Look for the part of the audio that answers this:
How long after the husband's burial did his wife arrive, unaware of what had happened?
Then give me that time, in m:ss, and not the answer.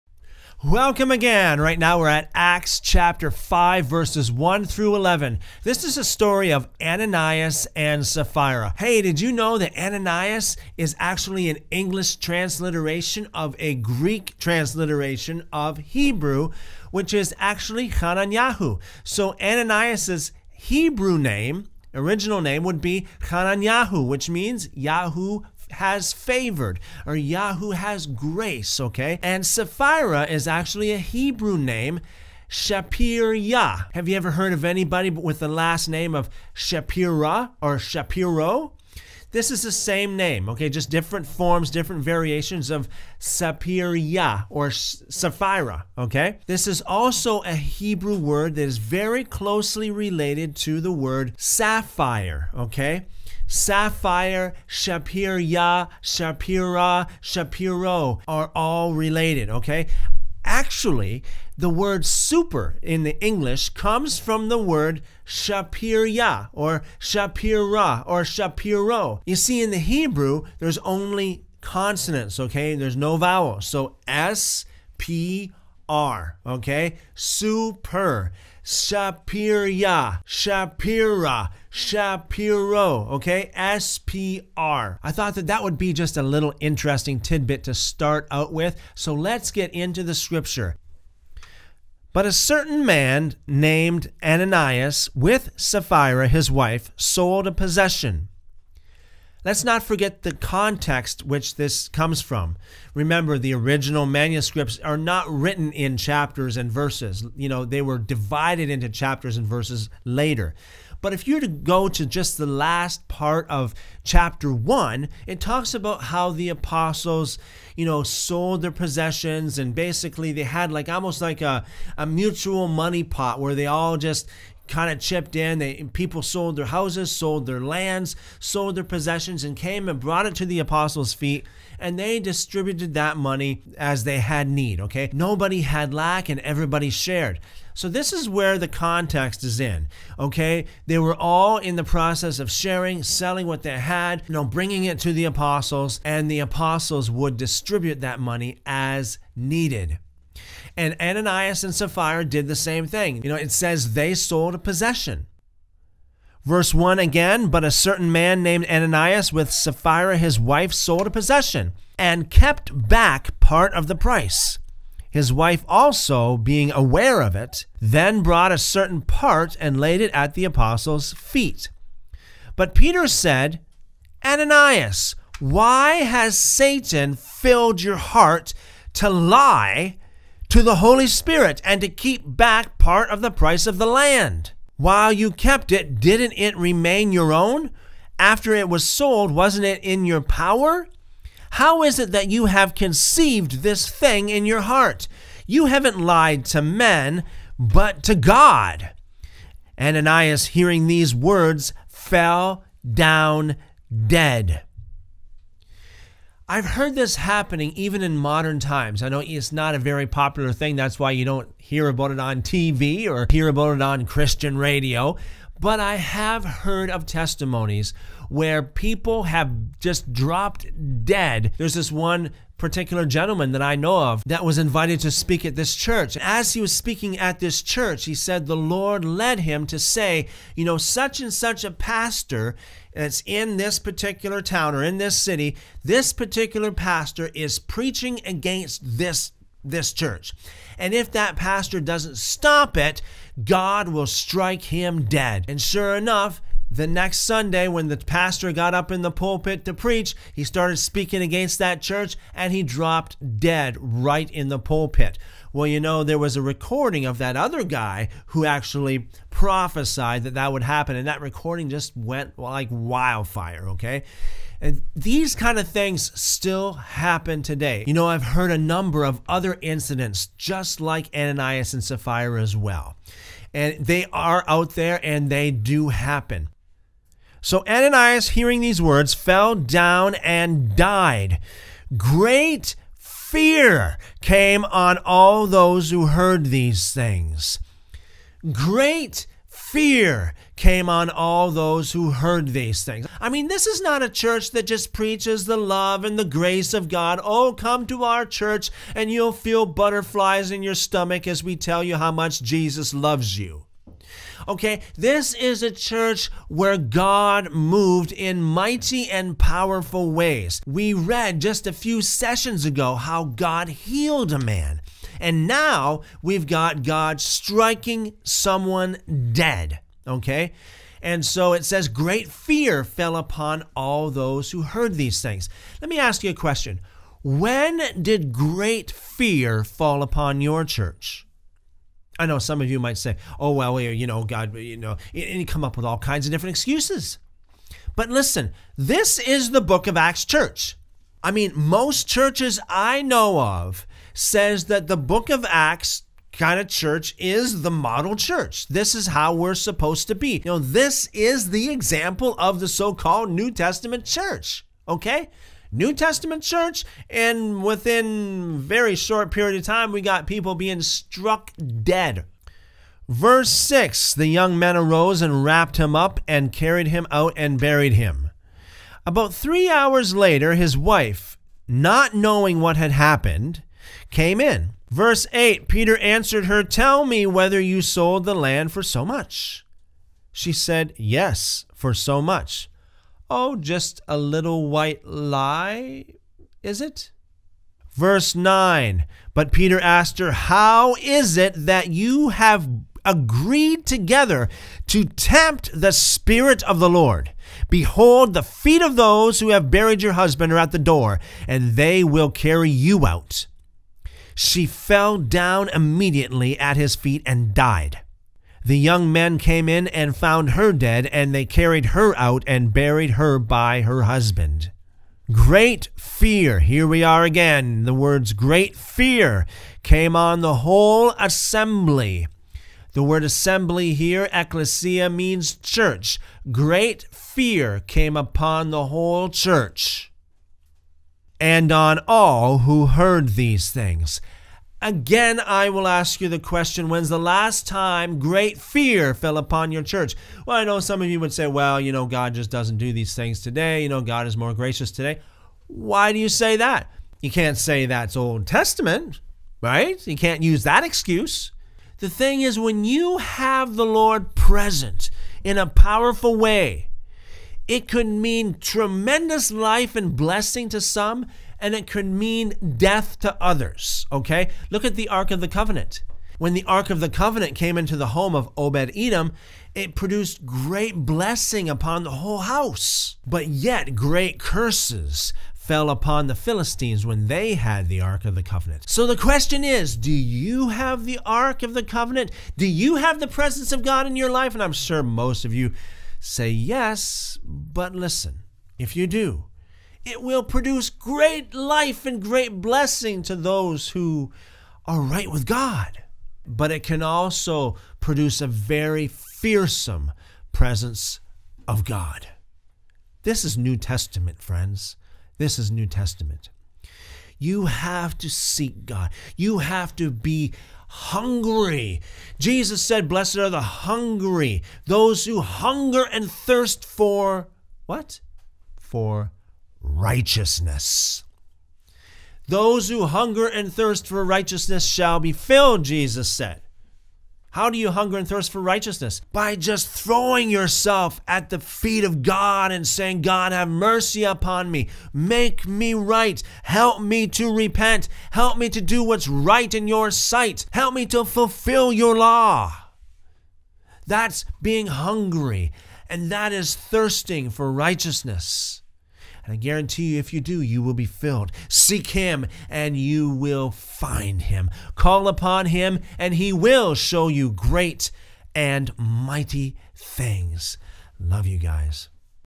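6:09.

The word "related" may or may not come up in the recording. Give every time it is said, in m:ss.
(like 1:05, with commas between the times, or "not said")
0:49, 0:58.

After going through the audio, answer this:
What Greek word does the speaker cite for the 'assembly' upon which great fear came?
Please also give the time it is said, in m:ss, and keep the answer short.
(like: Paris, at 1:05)
ecclesia, at 7:04.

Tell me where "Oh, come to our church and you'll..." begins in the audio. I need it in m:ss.
4:57.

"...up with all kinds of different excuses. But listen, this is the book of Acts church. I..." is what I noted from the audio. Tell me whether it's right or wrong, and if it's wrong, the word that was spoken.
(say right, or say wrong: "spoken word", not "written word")
right.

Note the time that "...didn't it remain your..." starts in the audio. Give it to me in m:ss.
3:06.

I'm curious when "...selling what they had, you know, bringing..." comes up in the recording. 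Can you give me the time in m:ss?
2:23.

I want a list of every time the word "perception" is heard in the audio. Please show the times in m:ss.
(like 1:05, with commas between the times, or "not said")
not said.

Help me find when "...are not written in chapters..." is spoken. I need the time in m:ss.
1:44.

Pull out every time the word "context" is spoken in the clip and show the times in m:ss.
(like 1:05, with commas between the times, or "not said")
1:40, 2:18.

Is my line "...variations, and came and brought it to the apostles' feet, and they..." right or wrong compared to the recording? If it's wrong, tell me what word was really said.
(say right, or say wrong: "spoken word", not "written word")
wrong: "possessions", not "variations".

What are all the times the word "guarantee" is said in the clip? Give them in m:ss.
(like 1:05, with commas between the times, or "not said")
9:09.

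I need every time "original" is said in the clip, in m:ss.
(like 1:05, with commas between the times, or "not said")
0:21, 1:43.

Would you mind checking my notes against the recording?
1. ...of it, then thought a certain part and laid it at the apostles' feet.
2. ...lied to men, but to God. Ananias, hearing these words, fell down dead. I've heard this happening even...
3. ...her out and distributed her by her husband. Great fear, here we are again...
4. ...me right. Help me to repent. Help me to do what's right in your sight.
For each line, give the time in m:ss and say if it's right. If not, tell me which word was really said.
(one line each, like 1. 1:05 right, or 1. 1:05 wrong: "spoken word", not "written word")
1. 2:47 wrong: "brought", not "thought"
2. 3:16 right
3. 6:51 wrong: "buried", not "distributed"
4. 8:55 right.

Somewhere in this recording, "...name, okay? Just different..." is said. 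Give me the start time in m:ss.
0:40.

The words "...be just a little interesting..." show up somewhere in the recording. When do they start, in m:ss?
1:25.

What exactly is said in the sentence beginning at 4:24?
And these kind of things still happen today.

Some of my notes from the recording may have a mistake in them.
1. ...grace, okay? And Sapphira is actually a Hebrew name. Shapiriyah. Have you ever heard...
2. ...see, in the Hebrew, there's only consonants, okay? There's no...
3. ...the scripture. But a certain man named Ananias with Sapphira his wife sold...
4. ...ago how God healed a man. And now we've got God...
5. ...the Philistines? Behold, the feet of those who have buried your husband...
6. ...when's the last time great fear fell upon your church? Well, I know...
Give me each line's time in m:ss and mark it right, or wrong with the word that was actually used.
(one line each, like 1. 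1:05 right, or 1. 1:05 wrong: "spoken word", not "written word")
1. 0:28 right
2. 1:09 right
3. 1:30 right
4. 5:12 right
5. 6:36 wrong: "Lord", not "Philistines"
6. 7:16 right.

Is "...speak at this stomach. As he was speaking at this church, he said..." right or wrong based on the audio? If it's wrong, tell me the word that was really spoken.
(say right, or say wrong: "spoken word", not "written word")
wrong: "church", not "stomach".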